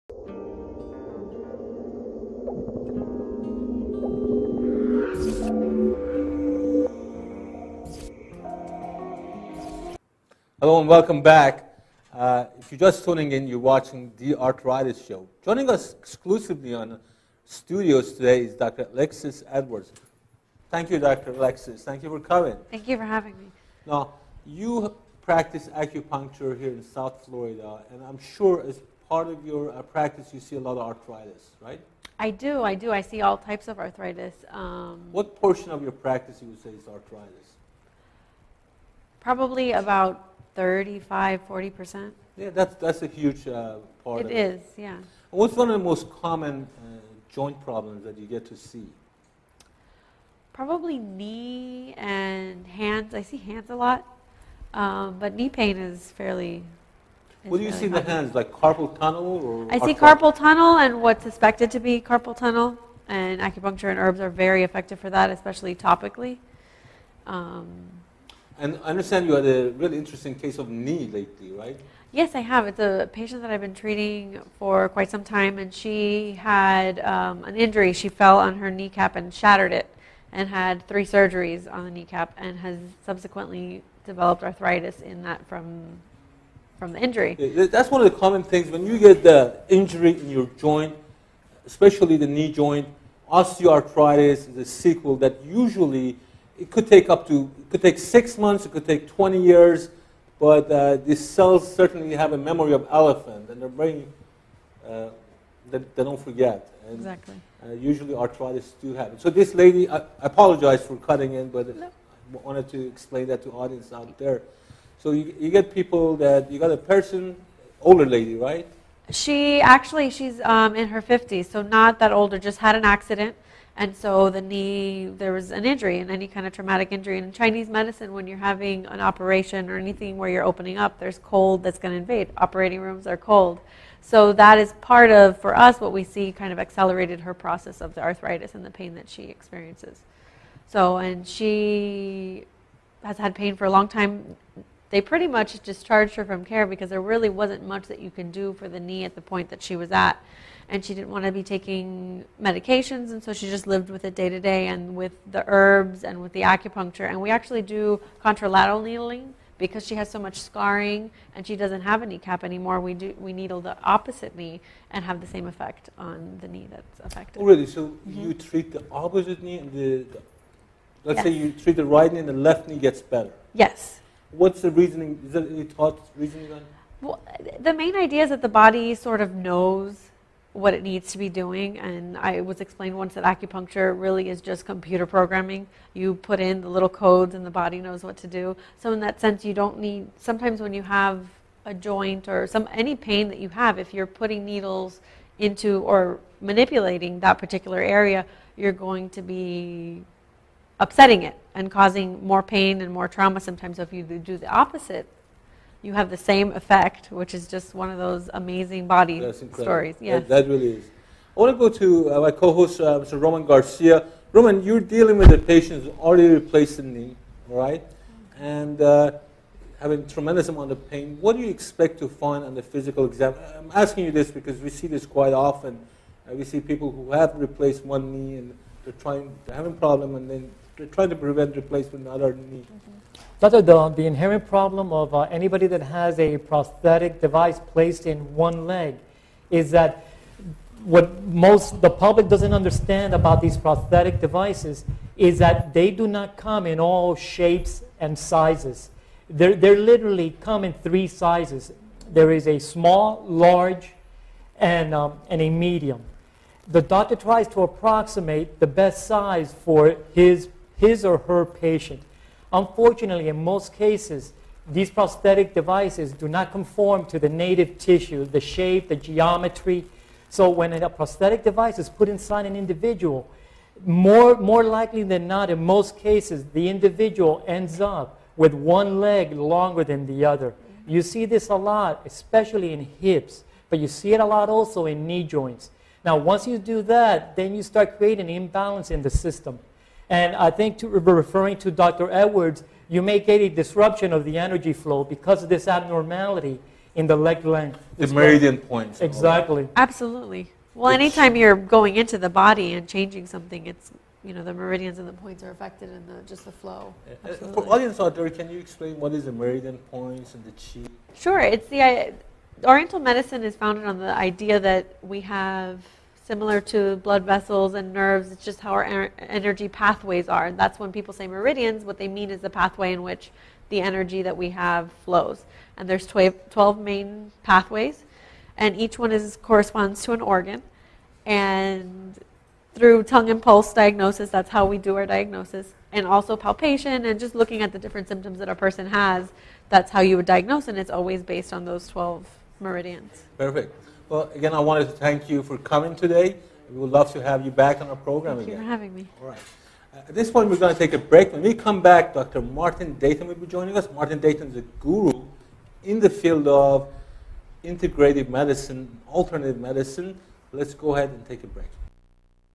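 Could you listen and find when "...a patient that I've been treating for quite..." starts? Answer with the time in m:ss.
1:12.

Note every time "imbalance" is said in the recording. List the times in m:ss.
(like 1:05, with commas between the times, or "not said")
4:48.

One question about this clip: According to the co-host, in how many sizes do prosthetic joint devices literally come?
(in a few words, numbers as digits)
3.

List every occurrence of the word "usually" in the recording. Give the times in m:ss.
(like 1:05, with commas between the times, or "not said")
1:35, 1:47.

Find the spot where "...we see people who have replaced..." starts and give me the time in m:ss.
3:46.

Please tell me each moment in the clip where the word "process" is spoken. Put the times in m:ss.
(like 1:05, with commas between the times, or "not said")
2:17.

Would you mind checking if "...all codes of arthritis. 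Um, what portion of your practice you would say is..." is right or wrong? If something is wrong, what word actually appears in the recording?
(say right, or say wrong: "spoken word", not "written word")
wrong: "types", not "codes".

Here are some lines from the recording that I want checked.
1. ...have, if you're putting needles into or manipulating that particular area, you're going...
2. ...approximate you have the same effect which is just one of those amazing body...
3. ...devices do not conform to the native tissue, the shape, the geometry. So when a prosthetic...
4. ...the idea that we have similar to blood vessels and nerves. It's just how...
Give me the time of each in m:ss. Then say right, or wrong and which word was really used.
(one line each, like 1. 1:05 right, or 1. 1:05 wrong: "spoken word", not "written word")
1. 3:13 right
2. 3:24 wrong: "opposite", not "approximate"
3. 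4:25 right
4. 5:13 right.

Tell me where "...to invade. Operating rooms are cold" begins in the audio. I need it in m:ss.
2:11.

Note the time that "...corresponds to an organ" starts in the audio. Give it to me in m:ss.
5:29.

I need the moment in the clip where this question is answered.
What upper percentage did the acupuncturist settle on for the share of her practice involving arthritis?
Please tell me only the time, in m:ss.
0:41.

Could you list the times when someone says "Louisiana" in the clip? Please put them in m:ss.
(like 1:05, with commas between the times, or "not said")
not said.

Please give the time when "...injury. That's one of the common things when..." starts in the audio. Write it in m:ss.
1:26.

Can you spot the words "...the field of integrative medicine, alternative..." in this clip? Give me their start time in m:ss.
5:56.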